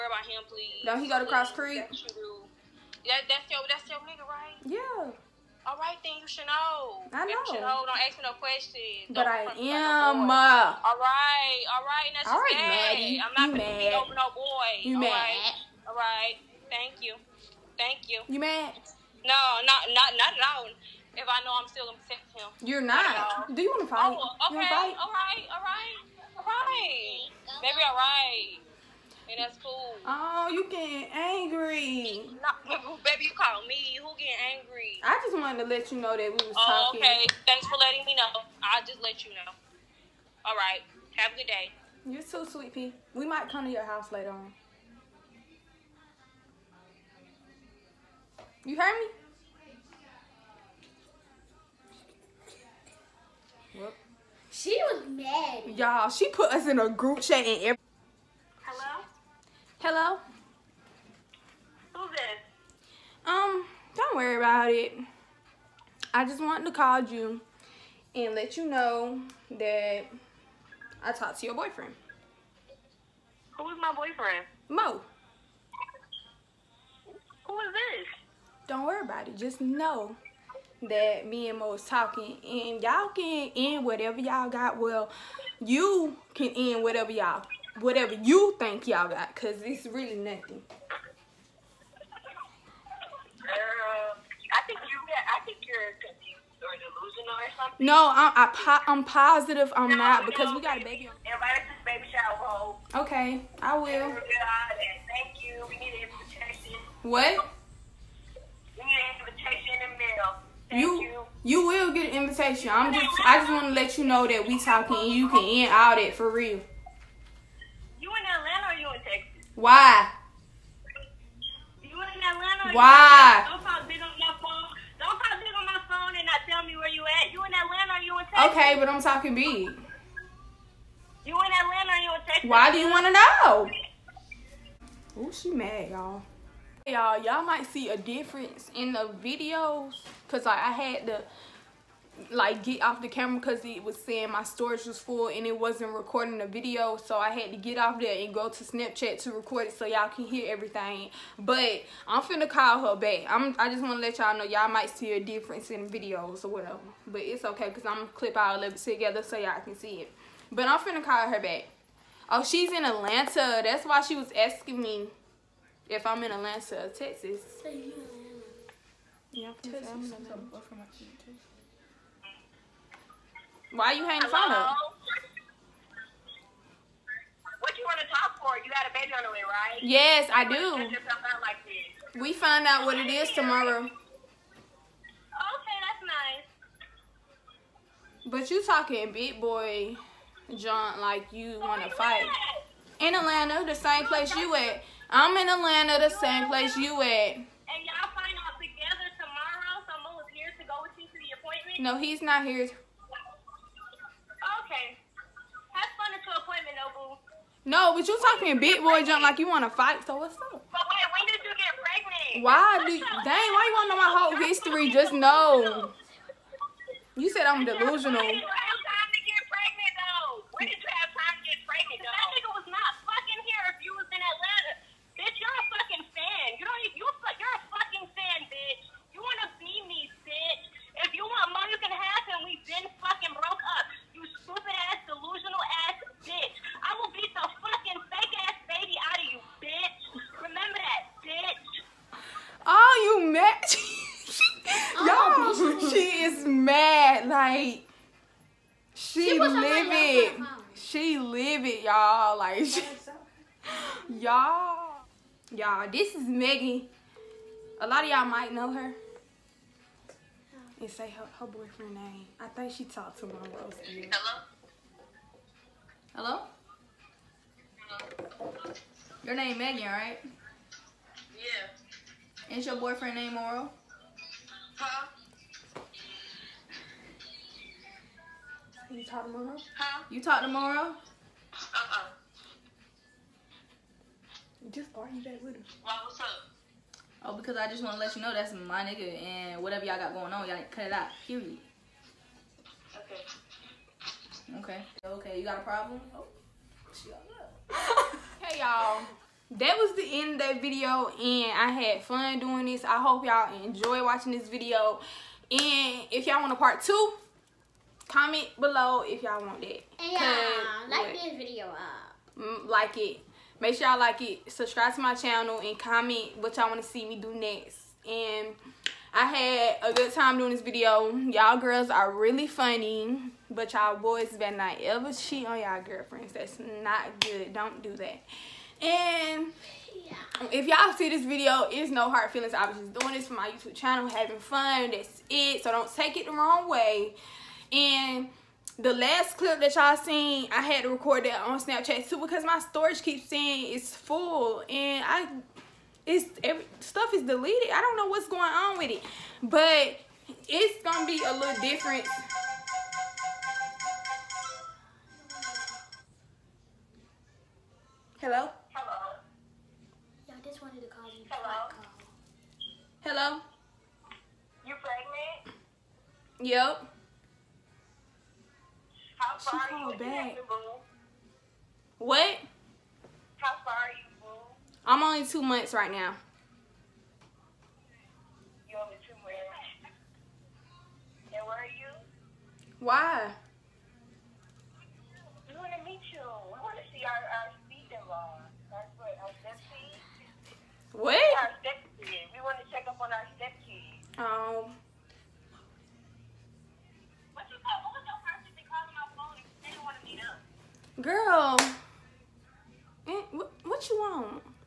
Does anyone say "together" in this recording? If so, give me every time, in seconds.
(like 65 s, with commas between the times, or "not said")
158 s, 198 s.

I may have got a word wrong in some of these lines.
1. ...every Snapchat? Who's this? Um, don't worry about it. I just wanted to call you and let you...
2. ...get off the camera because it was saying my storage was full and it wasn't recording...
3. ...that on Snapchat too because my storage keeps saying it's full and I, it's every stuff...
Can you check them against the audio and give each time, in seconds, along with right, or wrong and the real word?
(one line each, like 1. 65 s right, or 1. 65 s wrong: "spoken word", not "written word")
1. 57 s wrong: "Hello", not "Snapchat"
2. 142 s right
3. 341 s right.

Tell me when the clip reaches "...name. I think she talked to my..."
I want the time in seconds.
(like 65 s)
261 s.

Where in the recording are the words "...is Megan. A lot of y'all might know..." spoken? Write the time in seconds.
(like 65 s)
256 s.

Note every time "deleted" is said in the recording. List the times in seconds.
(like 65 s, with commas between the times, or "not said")
347 s.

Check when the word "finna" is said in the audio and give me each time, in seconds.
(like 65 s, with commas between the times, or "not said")
152 s, 160 s.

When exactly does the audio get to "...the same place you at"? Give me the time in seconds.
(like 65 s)
196 s.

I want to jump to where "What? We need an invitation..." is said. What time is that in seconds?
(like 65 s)
107 s.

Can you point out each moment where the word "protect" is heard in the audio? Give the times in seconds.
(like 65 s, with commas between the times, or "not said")
22 s.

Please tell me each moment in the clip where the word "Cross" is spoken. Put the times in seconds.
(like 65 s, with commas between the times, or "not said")
1 s.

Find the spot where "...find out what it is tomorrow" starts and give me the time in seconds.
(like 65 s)
182 s.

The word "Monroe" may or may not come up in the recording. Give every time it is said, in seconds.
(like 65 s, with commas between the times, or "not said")
273 s, 279 s.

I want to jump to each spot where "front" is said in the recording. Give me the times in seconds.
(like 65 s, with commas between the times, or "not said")
not said.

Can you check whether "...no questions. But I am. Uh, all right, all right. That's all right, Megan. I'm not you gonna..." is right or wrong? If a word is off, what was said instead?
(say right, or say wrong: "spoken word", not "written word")
wrong: "Maddie", not "Megan".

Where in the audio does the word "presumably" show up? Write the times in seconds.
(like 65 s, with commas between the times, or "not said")
not said.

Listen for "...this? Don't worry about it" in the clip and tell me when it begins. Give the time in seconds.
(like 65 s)
77 s.